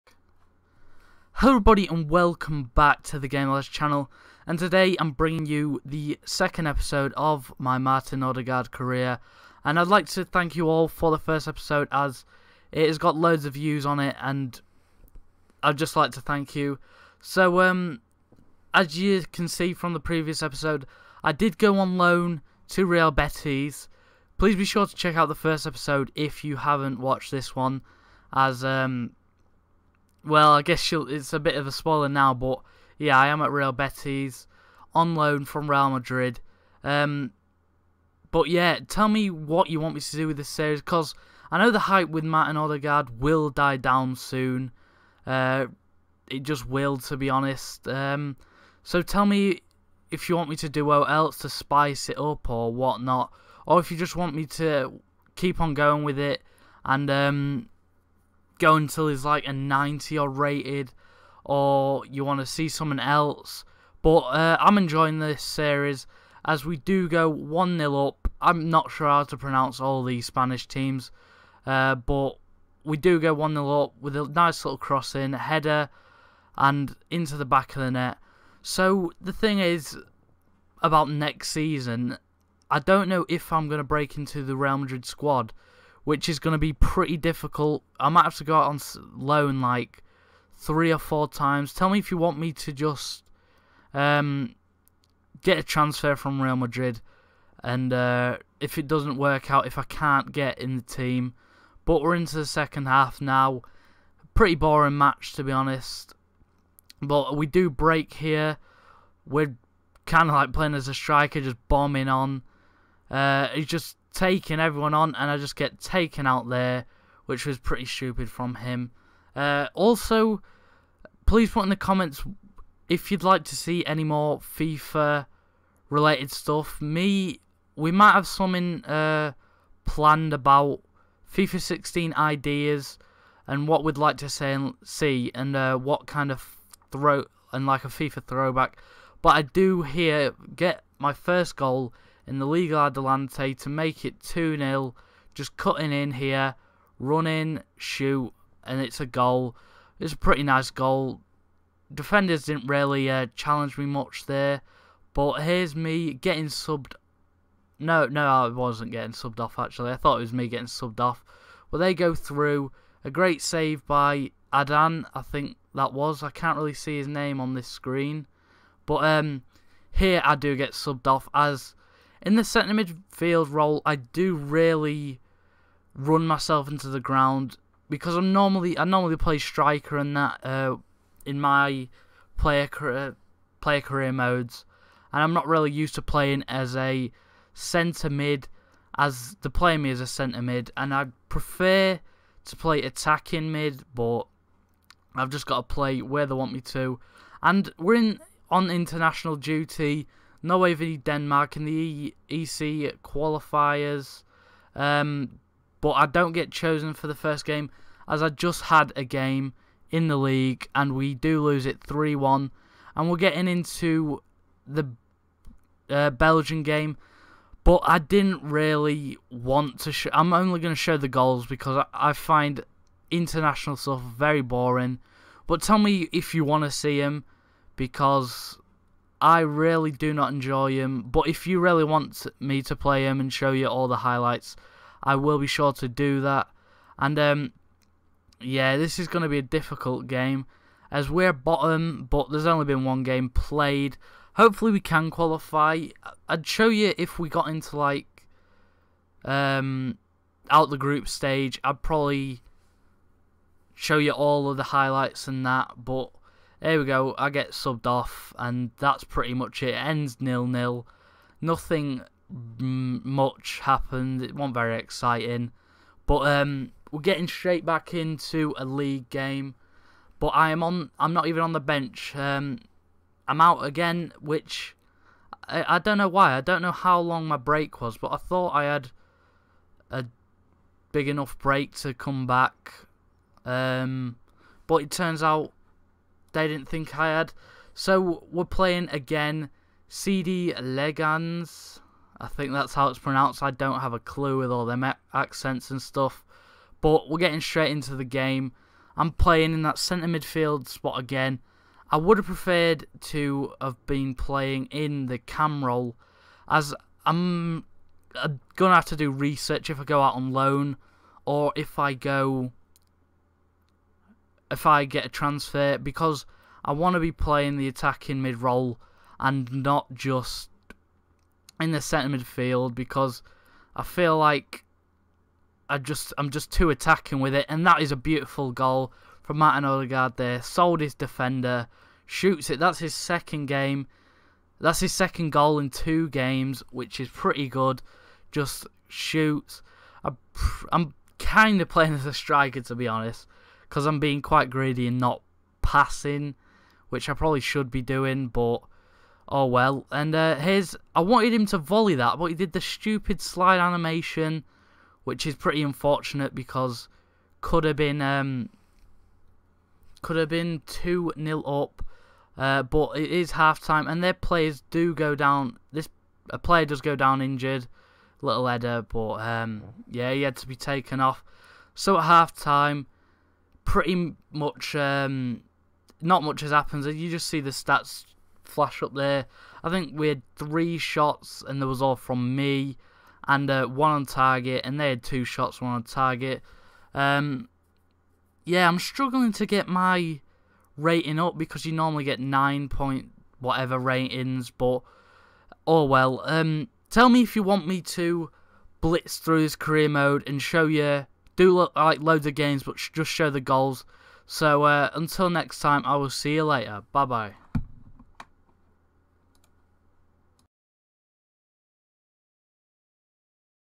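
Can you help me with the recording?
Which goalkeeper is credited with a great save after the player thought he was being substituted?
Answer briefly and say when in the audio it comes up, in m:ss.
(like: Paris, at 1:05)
Adan, at 2:44.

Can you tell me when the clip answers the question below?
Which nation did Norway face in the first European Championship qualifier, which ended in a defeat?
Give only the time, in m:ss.
3:20.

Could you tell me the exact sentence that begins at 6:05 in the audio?
This a player does go down injured, little header, but um, yeah, he had to be taken off.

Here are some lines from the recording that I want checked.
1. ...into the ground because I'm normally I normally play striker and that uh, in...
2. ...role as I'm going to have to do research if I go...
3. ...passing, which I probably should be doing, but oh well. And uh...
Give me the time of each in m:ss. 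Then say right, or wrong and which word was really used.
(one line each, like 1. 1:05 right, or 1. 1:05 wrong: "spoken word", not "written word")
1. 2:56 right
2. 5:05 right
3. 5:45 right.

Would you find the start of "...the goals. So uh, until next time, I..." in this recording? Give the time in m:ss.
6:43.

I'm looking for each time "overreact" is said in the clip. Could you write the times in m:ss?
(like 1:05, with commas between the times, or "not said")
not said.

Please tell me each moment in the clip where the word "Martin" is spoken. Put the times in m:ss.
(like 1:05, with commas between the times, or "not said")
0:07, 0:42, 5:29.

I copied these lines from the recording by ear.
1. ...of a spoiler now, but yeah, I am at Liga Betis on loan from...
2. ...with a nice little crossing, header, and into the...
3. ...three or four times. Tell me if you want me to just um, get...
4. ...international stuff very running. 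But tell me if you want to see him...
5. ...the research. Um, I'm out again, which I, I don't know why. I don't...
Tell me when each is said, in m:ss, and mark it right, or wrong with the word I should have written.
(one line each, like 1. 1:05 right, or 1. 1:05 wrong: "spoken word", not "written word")
1. 0:31 wrong: "Real", not "Liga"
2. 1:13 right
3. 1:30 right
4. 3:43 wrong: "boring", not "running"
5. 4:31 wrong: "bench", not "research".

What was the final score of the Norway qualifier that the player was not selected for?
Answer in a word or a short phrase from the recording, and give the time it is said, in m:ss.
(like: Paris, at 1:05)
3-1, at 3:31.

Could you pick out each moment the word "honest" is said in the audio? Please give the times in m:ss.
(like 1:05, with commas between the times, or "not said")
0:47, 1:45, 5:42.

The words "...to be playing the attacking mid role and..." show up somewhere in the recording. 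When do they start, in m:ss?
5:16.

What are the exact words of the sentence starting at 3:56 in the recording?
And um, yeah, this is going to be a difficult game as we're bottom, but there's only been one game played.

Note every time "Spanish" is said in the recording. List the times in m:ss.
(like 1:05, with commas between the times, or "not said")
1:10.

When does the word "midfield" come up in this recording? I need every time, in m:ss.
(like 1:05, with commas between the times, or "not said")
2:52, 5:00, 5:22.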